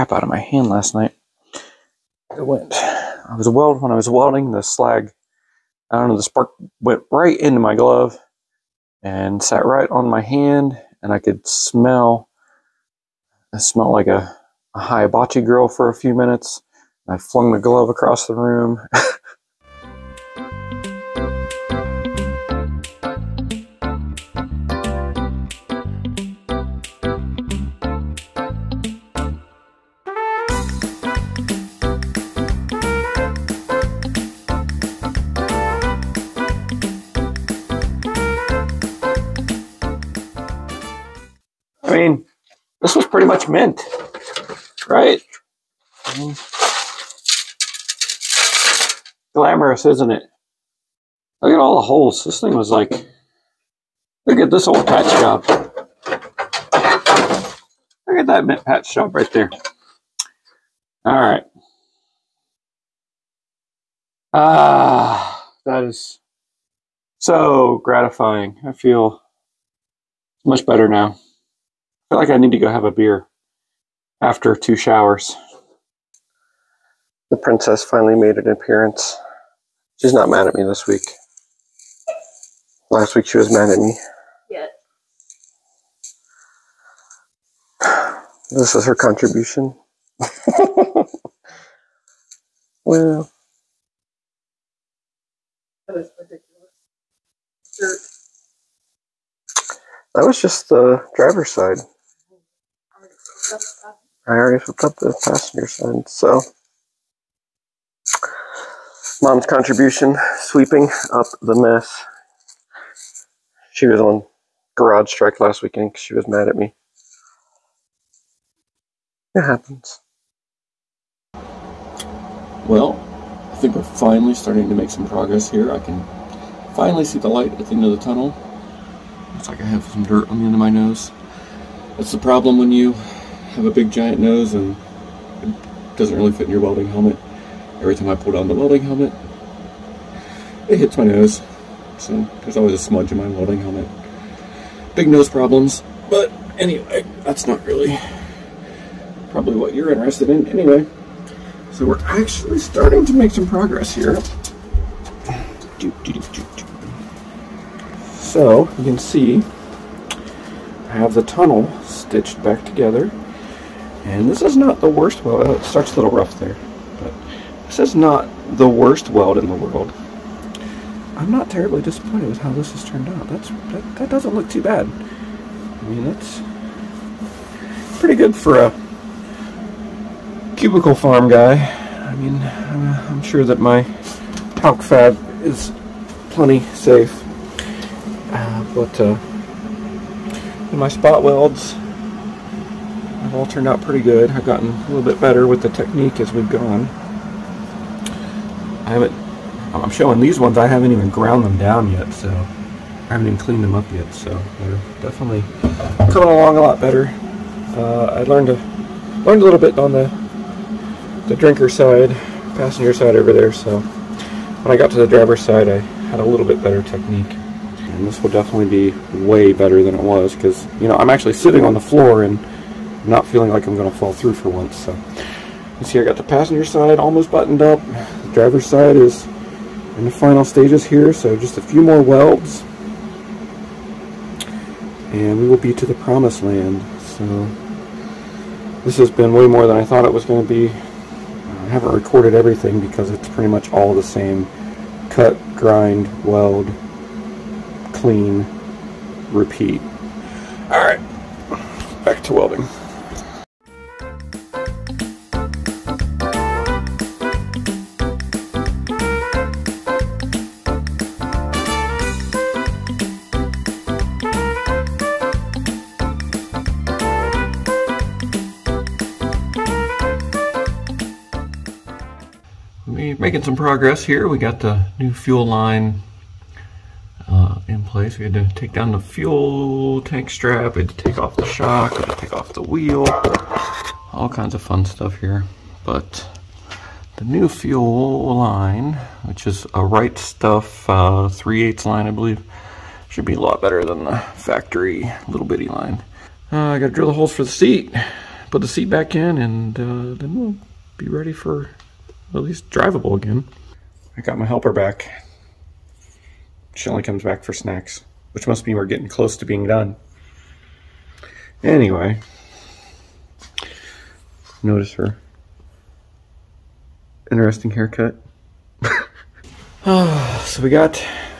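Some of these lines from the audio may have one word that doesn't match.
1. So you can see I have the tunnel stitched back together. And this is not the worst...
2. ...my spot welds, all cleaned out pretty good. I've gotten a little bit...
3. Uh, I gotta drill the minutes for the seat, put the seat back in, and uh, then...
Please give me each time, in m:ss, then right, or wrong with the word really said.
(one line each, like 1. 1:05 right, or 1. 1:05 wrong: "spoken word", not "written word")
1. 2:38 right
2. 3:10 wrong: "turned", not "cleaned"
3. 4:56 wrong: "holes", not "minutes".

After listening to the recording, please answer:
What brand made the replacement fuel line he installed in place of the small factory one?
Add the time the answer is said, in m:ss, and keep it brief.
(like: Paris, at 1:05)
Right Stuff, at 4:49.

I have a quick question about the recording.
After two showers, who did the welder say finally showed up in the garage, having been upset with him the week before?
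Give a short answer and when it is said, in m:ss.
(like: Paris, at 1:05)
The princess, at 1:17.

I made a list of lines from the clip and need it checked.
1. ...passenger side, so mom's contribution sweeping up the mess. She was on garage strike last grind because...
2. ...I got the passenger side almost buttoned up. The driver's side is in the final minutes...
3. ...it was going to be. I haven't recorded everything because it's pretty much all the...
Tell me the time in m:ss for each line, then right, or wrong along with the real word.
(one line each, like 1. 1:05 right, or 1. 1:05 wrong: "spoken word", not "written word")
1. 1:45 wrong: "weekend", not "grind"
2. 3:45 wrong: "stages", not "minutes"
3. 4:00 right.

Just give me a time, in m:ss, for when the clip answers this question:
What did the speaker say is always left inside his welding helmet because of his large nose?
2:22.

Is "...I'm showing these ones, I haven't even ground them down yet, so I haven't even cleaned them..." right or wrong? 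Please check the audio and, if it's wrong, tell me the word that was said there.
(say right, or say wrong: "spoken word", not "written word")
right.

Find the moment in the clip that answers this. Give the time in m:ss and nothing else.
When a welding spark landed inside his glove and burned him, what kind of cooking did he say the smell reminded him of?
0:14.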